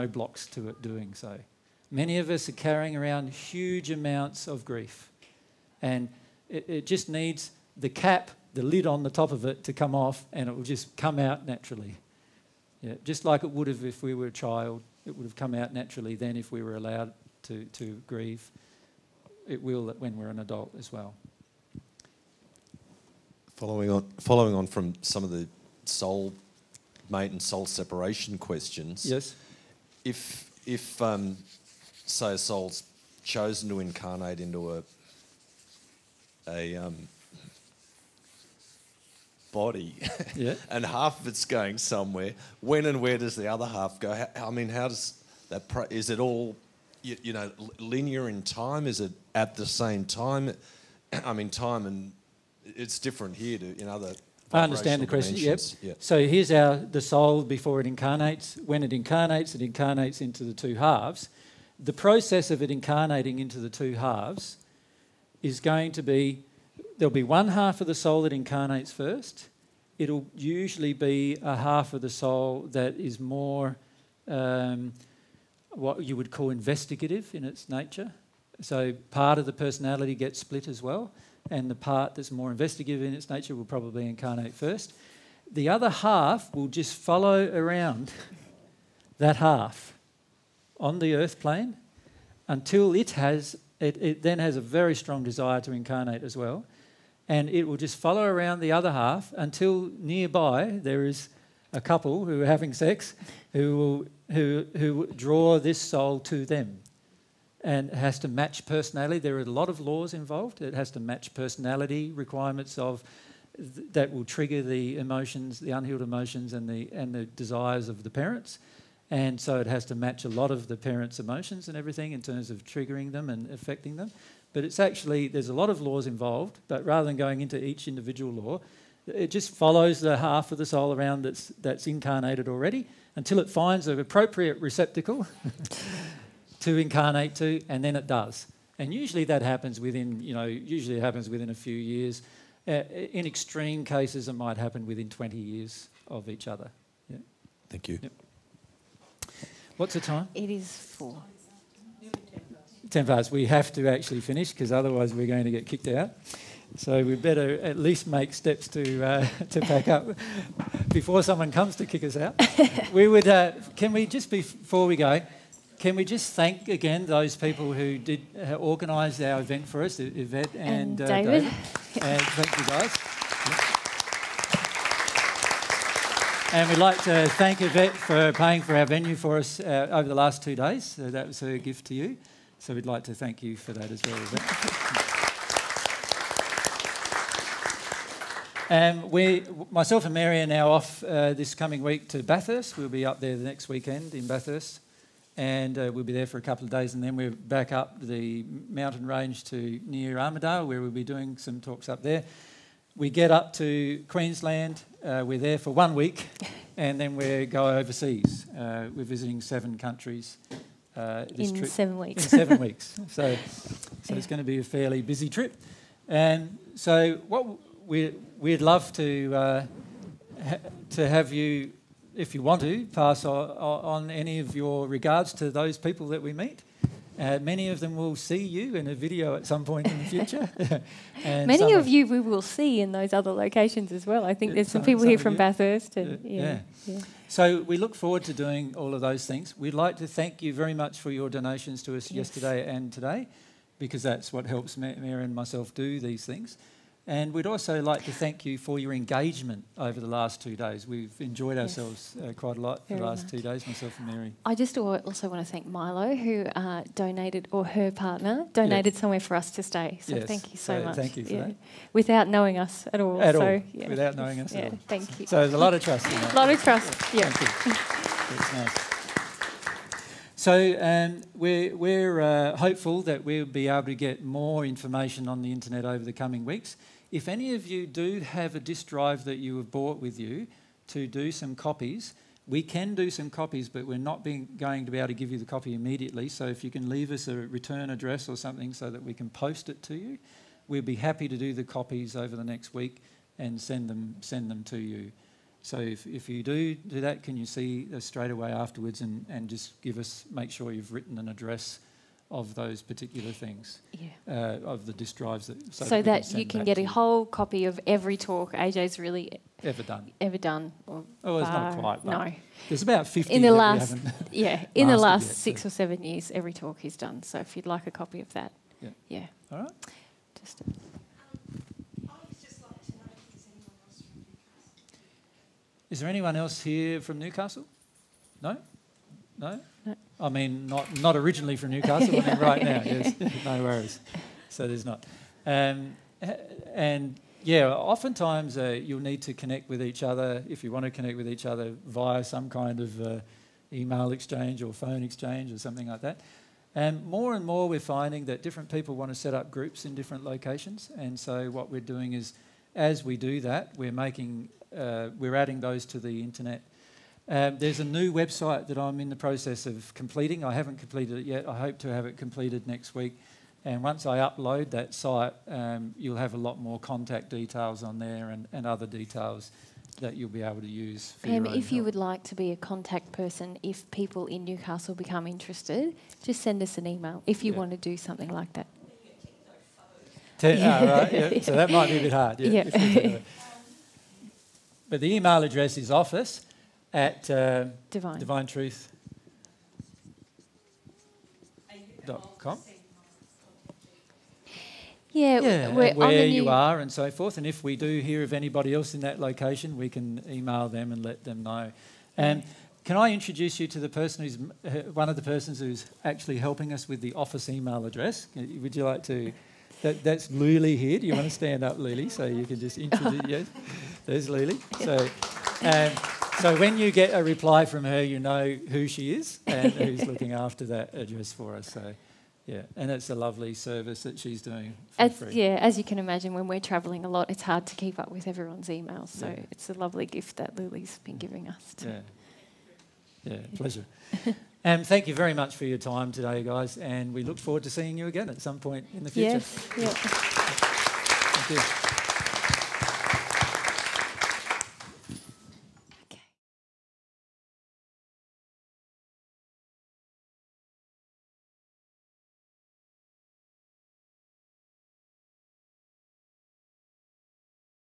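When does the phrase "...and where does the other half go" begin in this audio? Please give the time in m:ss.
0:42.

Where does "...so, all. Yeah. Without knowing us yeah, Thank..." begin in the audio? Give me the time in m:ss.
4:23.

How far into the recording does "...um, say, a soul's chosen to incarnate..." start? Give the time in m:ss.
0:31.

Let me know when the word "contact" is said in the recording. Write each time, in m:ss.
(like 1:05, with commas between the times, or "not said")
6:06, 6:12.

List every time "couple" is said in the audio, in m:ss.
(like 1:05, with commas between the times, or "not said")
1:41, 3:16.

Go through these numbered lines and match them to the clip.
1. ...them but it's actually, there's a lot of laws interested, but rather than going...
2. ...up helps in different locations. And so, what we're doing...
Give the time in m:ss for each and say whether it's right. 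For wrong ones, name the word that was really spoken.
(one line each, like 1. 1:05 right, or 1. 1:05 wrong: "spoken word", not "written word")
1. 2:03 wrong: "involved", not "interested"
2. 5:49 wrong: "groups", not "helps".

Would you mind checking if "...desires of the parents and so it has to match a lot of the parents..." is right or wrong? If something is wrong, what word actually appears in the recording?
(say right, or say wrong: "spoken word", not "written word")
right.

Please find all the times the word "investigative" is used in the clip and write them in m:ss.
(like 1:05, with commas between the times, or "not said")
1:16, 1:22.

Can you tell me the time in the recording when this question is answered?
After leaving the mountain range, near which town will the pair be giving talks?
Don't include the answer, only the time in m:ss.
3:20.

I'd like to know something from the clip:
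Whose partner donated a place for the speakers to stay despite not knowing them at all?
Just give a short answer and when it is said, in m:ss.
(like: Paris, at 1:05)
Milo, at 4:15.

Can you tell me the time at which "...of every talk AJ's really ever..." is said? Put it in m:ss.
5:07.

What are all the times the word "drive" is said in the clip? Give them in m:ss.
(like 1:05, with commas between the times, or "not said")
4:38, 5:05.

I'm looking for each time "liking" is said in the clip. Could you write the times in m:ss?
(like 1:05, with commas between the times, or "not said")
not said.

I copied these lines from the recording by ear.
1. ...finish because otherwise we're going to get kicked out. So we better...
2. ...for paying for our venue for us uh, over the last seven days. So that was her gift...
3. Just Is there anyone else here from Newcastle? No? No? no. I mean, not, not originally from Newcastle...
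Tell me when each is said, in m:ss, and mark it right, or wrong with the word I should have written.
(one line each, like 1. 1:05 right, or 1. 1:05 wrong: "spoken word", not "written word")
1. 2:34 right
2. 2:57 wrong: "two", not "seven"
3. 5:20 right.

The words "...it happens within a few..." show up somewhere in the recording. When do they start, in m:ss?
2:20.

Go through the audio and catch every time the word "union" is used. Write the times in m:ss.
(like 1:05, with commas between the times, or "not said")
not said.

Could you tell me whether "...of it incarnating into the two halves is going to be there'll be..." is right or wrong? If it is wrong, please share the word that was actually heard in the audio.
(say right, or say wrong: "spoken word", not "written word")
right.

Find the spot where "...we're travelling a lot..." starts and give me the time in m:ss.
7:06.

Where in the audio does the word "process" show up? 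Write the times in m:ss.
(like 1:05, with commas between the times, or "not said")
1:01, 5:59.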